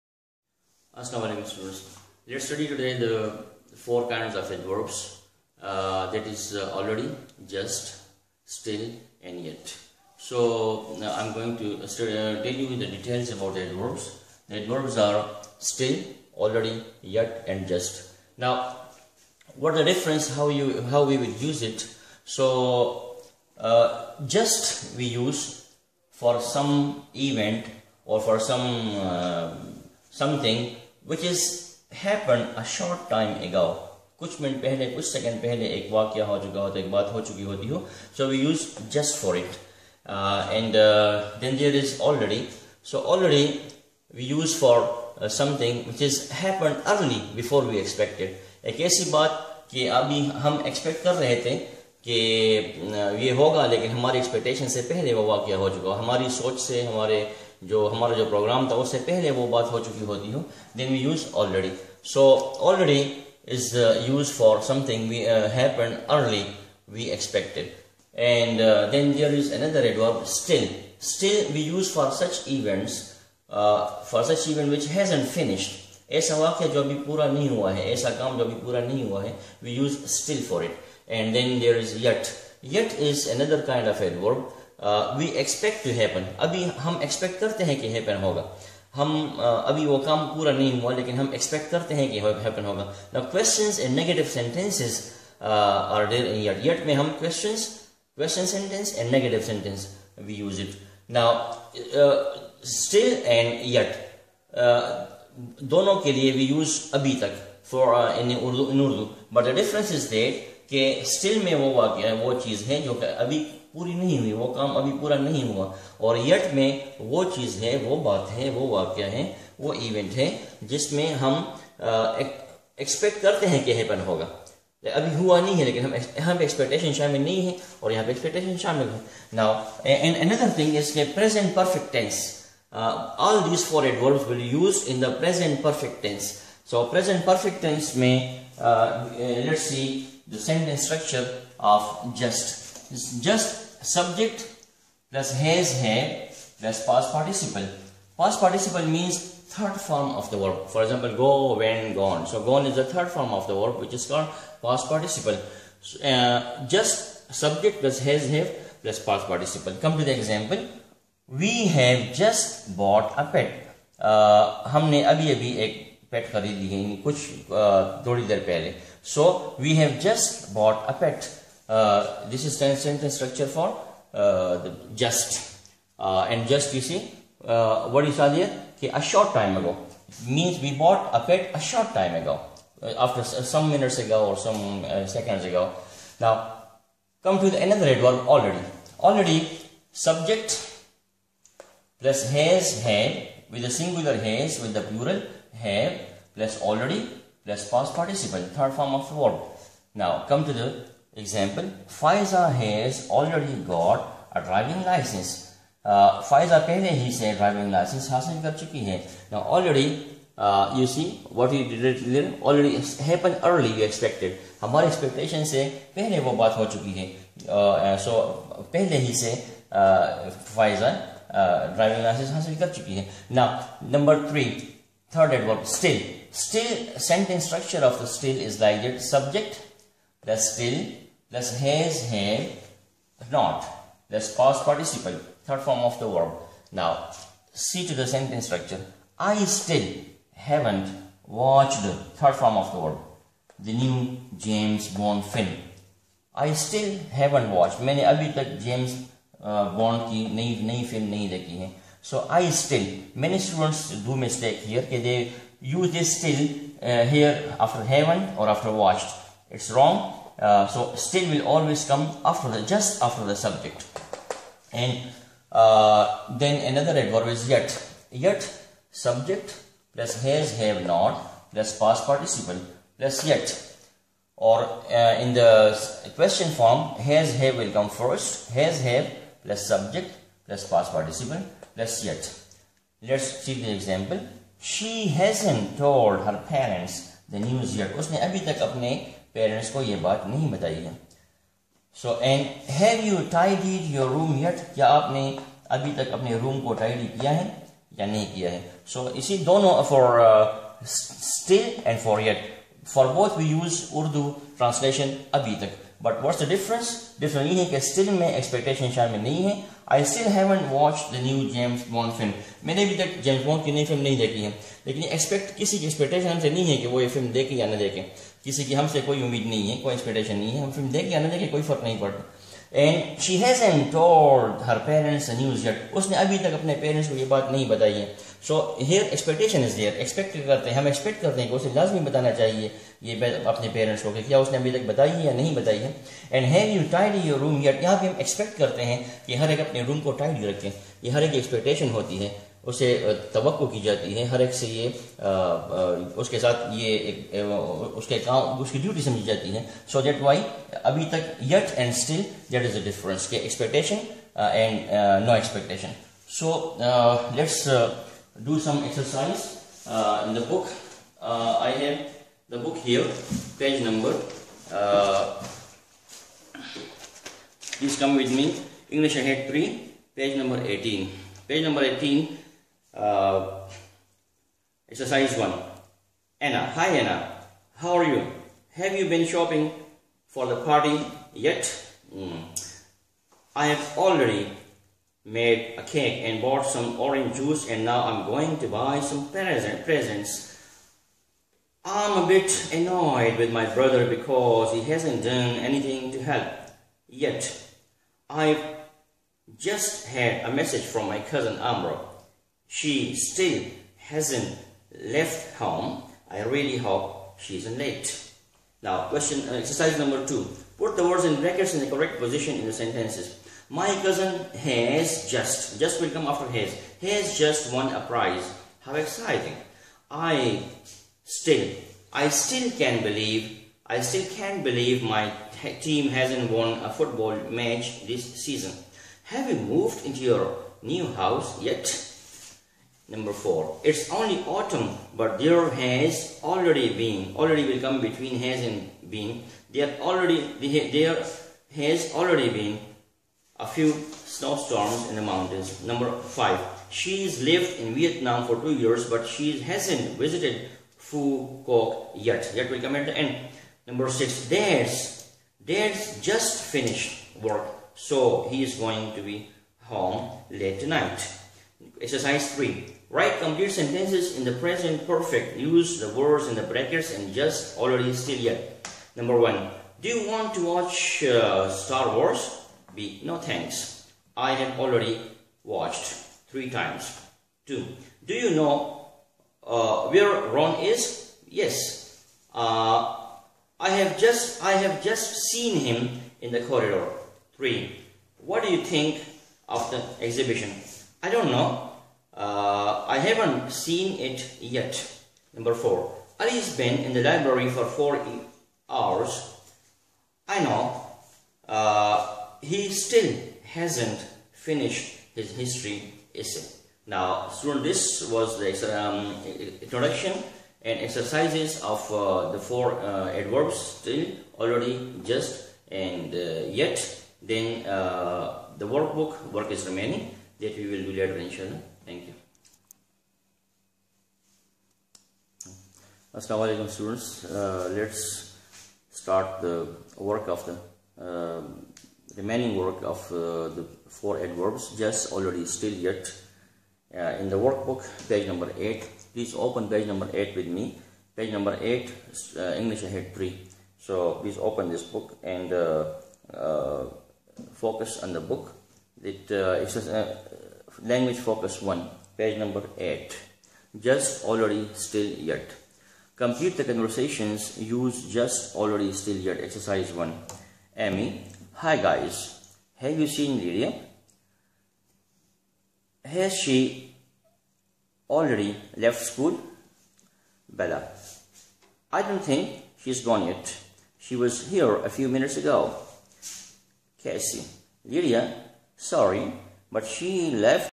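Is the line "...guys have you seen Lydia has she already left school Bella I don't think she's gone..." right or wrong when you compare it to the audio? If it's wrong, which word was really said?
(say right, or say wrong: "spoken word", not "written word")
right.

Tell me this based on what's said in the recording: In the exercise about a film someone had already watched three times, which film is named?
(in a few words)
Star Wars.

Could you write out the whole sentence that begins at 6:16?
Anna, hi Anna, how are you?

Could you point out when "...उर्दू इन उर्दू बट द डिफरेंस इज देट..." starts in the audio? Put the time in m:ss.
1:48.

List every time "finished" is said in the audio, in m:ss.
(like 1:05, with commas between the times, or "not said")
7:36, 8:24.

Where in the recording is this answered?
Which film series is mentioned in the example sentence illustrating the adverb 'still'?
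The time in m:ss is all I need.
4:04.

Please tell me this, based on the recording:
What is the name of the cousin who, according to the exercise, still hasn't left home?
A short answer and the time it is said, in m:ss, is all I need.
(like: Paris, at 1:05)
Amro, at 6:41.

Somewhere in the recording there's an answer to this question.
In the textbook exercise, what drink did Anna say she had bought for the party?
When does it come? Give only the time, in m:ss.
6:26.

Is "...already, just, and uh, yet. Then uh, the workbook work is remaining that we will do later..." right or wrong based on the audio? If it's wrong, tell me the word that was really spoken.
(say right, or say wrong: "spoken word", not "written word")
right.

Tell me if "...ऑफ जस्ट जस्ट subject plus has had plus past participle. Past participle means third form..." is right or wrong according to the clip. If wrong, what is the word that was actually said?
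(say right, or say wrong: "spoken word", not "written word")
right.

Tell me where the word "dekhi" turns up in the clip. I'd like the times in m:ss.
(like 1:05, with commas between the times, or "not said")
4:11.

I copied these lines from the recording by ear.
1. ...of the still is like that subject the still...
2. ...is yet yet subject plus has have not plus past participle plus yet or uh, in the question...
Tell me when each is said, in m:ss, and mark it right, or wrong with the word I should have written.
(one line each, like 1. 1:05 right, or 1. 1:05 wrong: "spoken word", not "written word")
1. 3:47 right
2. 4:27 right.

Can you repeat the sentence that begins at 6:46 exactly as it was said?
I really hope she isn't late.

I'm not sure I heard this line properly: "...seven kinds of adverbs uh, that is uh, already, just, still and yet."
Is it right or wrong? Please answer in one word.
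wrong.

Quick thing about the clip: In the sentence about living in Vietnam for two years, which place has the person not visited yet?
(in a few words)
Phu Quoc.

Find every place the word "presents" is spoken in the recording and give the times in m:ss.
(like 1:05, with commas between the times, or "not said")
6:29, 7:44.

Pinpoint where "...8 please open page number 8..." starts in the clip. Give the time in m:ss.
8:58.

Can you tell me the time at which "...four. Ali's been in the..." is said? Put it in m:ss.
8:15.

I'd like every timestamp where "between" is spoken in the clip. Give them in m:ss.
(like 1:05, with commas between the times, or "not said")
7:17.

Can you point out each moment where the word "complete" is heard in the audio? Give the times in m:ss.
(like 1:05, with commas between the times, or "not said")
7:43, 9:16.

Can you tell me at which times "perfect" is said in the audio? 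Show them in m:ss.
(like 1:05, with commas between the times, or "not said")
7:45.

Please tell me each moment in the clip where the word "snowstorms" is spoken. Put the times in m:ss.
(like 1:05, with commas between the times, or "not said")
7:24.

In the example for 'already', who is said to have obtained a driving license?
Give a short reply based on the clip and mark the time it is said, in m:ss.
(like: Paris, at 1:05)
Faiza, at 3:21.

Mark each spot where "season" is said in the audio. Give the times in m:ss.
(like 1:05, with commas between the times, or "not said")
7:08.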